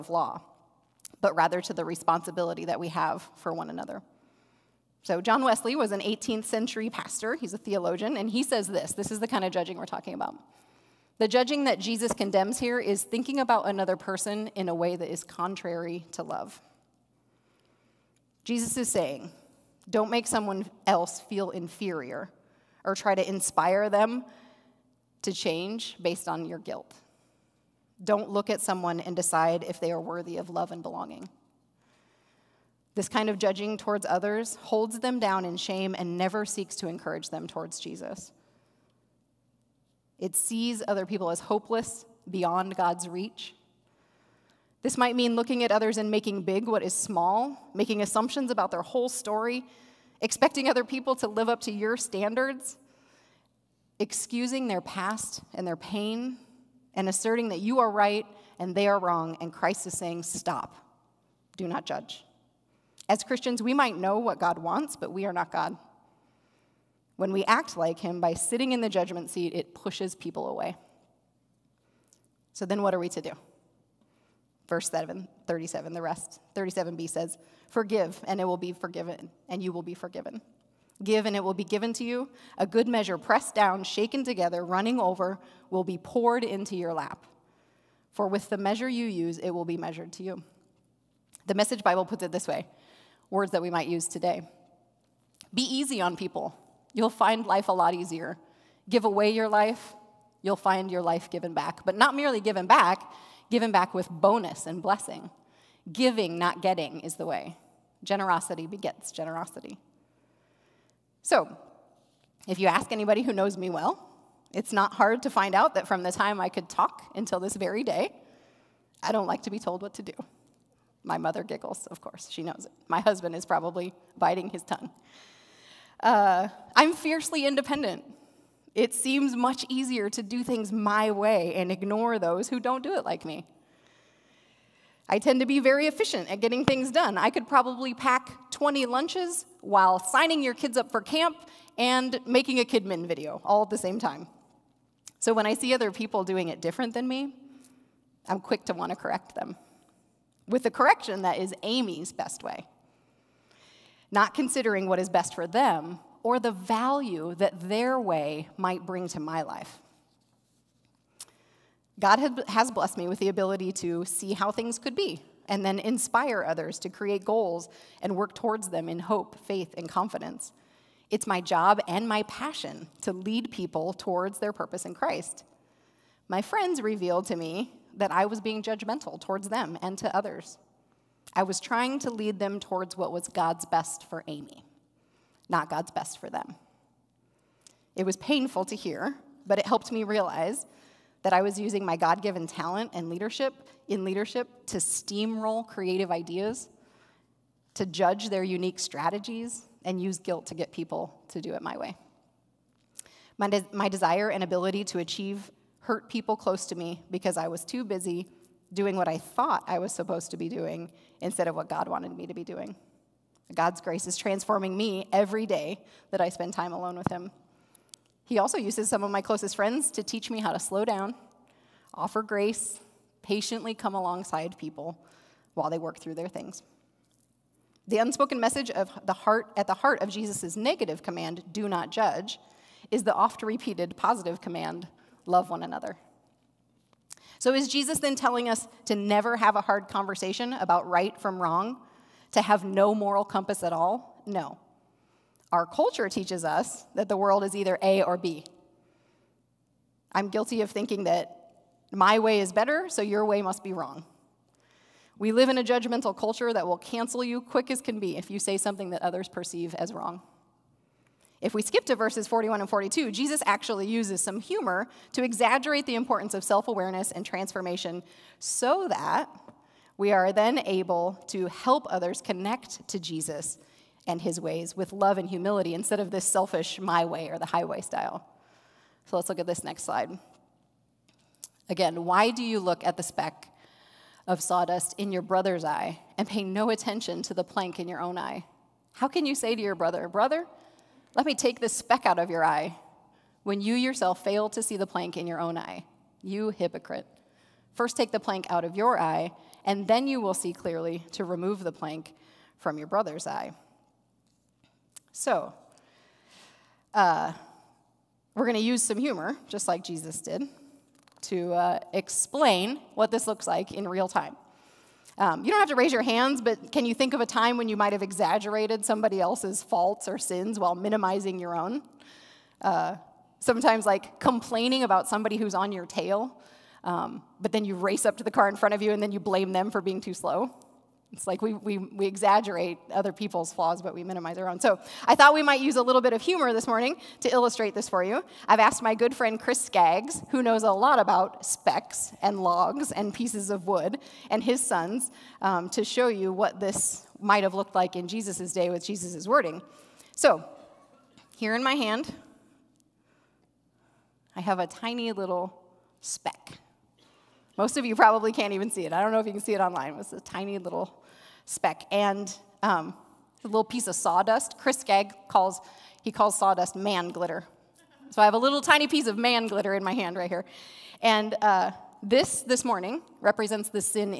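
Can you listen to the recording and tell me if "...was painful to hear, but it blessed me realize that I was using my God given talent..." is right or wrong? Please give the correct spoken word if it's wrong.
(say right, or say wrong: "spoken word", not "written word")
wrong: "helped", not "blessed".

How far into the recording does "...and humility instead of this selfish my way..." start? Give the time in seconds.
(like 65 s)
275 s.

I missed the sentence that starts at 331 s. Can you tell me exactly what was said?
It's like we, we, we exaggerate other people's flaws, but we minimize our own.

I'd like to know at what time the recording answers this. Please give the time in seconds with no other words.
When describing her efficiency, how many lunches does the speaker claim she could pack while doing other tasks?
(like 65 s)
138 s.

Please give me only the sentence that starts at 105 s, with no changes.
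Giving, not getting, is the way.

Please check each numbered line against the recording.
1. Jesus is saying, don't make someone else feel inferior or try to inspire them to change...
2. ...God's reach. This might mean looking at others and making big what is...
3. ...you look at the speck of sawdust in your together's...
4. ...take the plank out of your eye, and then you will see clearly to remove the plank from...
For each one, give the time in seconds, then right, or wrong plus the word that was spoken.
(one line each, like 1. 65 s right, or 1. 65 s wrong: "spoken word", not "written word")
1. 18 s right
2. 42 s right
3. 282 s wrong: "brother", not "together"
4. 297 s right.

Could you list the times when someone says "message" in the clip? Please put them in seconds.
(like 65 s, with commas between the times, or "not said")
91 s, 228 s.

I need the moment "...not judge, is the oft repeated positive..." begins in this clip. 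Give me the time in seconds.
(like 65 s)
231 s.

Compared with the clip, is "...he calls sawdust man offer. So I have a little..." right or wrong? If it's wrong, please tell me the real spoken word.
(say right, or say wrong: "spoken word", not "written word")
wrong: "glitter", not "offer".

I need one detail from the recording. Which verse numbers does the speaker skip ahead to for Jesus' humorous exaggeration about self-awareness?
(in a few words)
41 and 42.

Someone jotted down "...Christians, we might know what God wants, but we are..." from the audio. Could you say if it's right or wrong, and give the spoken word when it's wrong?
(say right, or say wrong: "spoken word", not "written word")
right.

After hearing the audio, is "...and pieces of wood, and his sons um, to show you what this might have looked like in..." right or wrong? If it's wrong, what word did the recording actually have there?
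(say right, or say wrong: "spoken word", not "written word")
right.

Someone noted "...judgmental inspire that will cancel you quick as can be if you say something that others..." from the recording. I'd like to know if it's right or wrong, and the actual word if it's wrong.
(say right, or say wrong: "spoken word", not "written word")
wrong: "culture", not "inspire".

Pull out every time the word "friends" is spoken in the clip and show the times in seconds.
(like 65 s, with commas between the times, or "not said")
176 s, 219 s, 339 s.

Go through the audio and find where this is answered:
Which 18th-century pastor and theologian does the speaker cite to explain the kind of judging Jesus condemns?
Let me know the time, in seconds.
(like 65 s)
5 s.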